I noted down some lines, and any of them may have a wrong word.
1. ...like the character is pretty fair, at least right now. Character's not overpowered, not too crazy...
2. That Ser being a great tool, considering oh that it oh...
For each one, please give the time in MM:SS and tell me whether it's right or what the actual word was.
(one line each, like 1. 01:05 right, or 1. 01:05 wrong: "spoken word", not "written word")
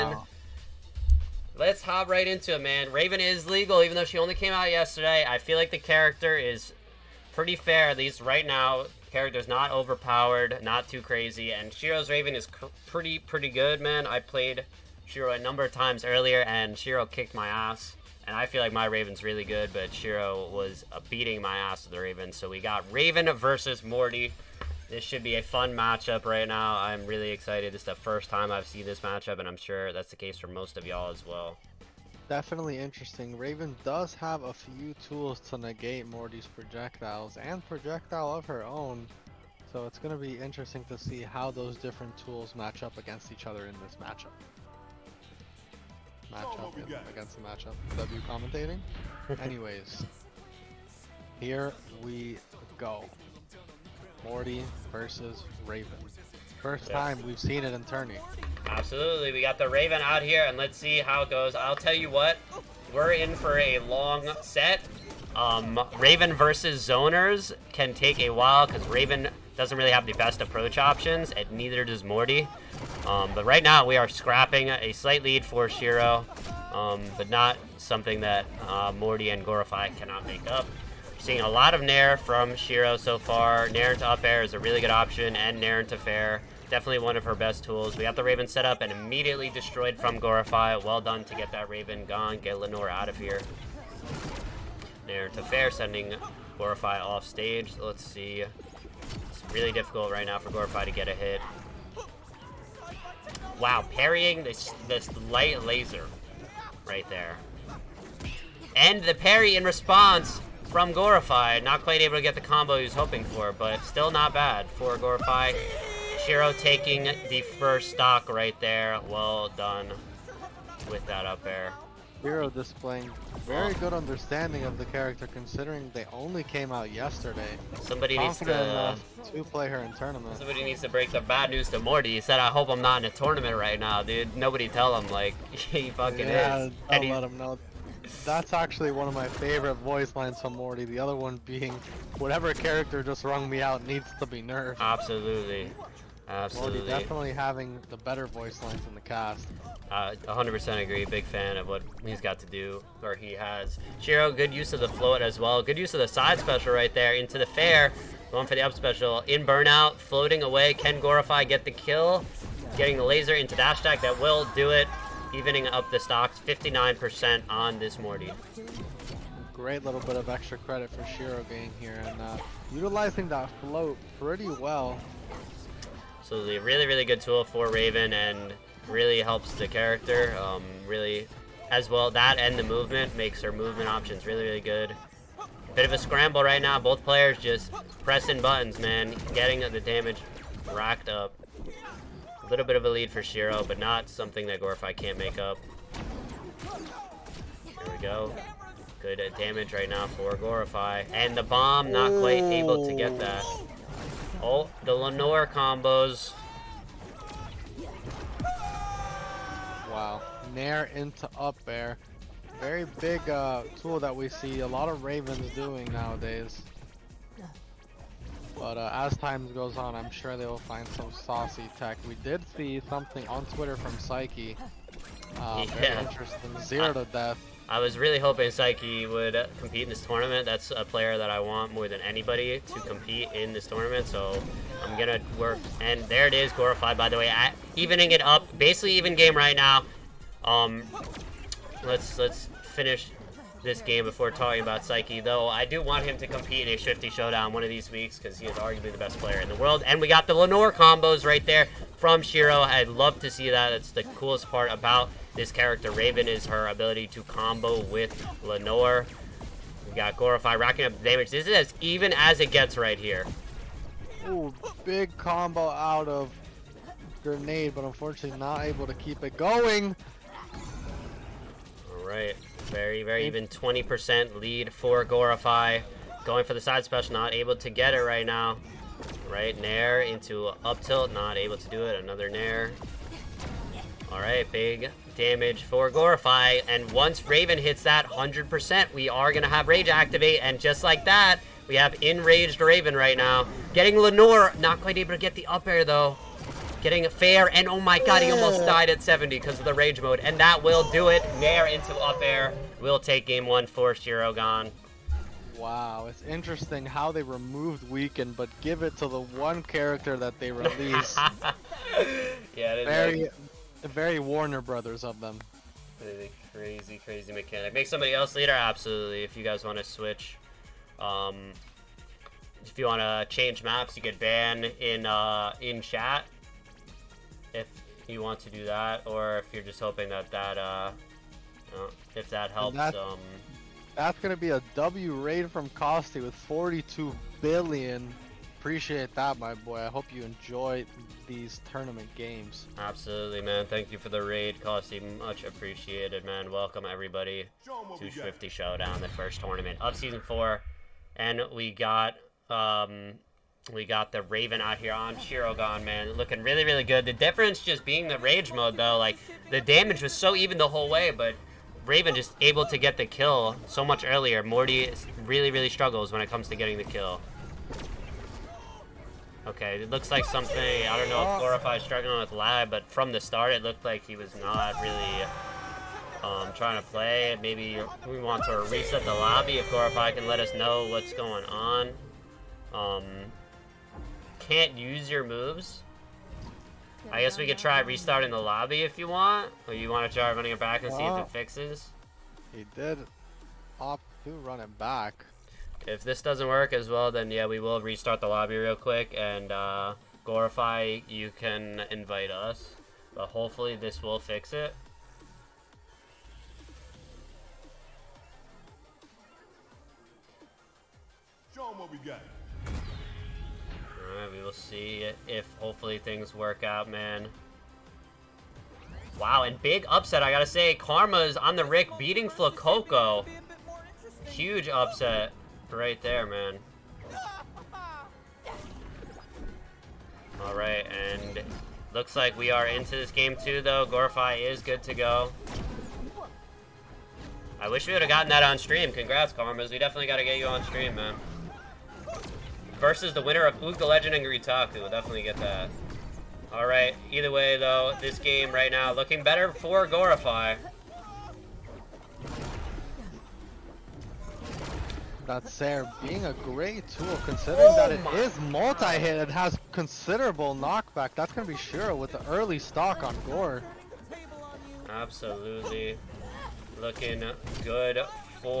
1. 00:05 right
2. 07:35 right.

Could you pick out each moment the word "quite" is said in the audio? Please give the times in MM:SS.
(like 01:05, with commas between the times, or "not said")
01:51, 03:22, 04:54.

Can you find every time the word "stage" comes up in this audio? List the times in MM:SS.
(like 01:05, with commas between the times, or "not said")
01:37.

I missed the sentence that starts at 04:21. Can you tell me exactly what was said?
This is as even as it gets right here.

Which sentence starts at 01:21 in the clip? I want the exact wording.
Seeing a lot of Nair from Shiro so far.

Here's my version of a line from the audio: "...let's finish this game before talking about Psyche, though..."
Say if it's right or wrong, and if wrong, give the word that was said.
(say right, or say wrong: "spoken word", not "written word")
right.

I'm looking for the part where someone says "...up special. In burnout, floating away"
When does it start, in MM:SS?
02:38.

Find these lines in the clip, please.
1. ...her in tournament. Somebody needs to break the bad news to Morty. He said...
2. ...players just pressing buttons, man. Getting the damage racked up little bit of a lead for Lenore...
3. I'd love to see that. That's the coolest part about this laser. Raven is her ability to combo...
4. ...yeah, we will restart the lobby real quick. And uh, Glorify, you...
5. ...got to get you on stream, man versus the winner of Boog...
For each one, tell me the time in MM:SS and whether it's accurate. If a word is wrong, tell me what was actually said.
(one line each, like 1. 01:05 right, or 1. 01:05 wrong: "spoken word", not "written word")
1. 02:09 right
2. 03:07 wrong: "Shiro", not "Lenore"
3. 04:12 wrong: "character", not "laser"
4. 06:37 right
5. 07:20 right.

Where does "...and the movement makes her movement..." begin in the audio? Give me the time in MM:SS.
03:02.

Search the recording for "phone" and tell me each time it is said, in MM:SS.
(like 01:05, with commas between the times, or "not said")
not said.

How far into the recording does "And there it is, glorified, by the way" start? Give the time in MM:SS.
03:55.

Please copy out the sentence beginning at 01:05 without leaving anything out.
Um, Raven versus Zoners can take a while because Raven doesn't really have the best approach options, and neither does Morty.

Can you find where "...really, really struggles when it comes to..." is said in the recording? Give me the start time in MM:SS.
06:05.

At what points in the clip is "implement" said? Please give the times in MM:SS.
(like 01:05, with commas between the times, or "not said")
not said.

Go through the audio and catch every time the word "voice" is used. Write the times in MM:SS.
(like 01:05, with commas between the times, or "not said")
02:19, 02:28.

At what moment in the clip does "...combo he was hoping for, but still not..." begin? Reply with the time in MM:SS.
01:52.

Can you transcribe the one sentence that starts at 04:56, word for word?
Getting a fair, and oh my god, he almost died at 70 because of the rage mode.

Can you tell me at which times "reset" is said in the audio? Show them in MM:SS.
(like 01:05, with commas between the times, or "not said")
06:18.